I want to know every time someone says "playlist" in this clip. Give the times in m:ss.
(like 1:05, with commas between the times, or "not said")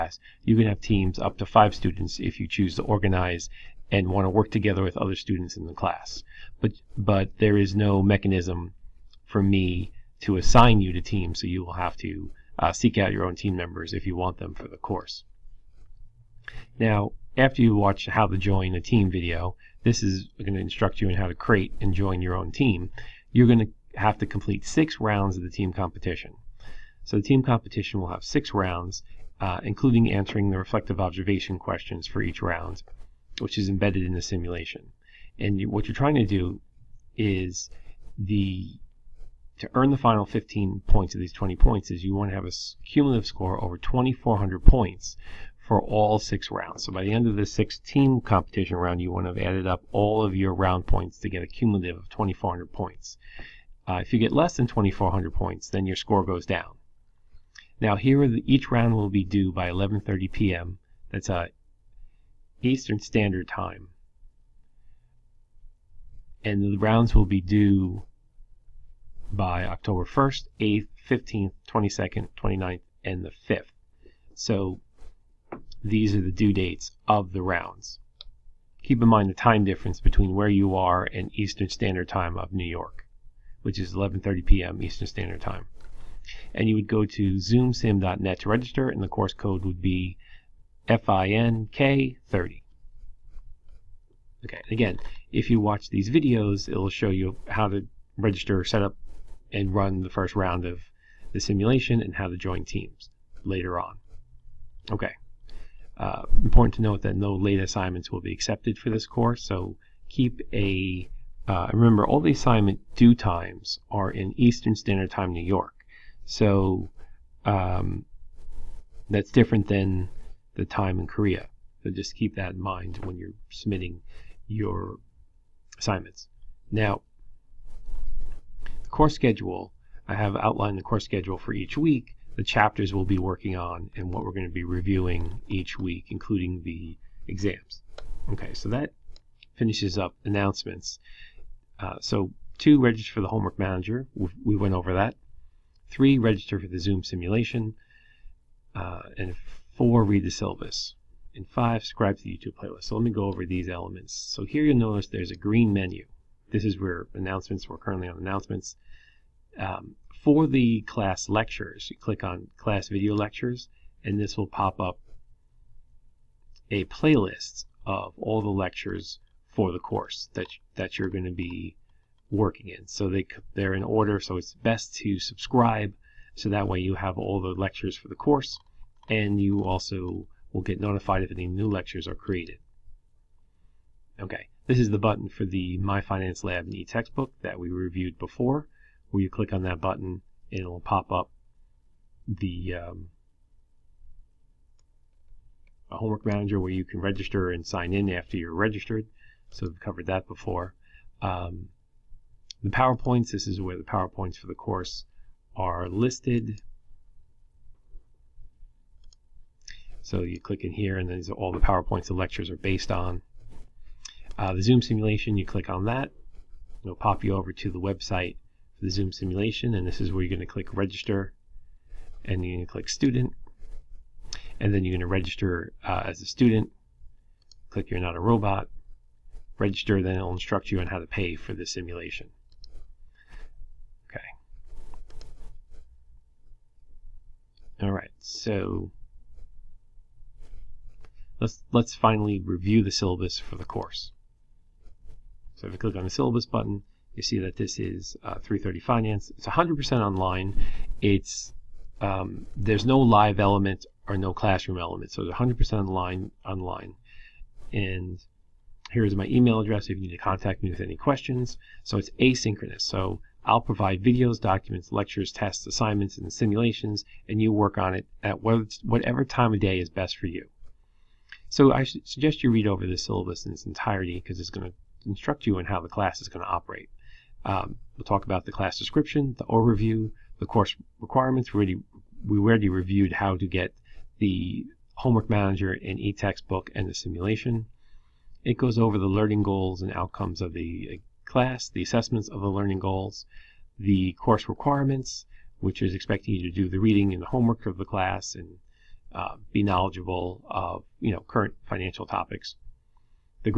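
2:32, 2:46.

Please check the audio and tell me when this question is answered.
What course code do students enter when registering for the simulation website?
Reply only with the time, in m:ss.
1:30.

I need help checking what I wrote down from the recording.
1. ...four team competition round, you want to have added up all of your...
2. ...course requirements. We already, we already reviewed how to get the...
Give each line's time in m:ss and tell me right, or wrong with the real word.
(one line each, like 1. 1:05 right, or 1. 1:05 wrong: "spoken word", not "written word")
1. 0:47 wrong: "six", not "four"
2. 4:40 right.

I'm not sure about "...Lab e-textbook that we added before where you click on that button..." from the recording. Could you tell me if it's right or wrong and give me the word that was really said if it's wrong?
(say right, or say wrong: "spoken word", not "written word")
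wrong: "reviewed", not "added".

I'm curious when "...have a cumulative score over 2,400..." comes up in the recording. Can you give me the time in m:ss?
0:42.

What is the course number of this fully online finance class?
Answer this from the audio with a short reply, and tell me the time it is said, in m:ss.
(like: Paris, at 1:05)
330, at 4:08.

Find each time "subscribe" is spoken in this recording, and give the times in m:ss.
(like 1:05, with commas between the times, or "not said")
2:31, 2:55.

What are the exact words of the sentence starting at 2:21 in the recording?
Uh, so two, register for the homework manager.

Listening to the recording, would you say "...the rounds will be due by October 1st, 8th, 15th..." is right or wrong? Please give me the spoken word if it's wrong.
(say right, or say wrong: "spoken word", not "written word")
right.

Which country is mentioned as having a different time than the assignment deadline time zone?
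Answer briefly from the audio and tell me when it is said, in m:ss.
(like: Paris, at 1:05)
Korea, at 2:01.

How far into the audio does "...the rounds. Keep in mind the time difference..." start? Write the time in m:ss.
1:17.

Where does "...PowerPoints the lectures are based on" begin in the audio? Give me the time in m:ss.
3:31.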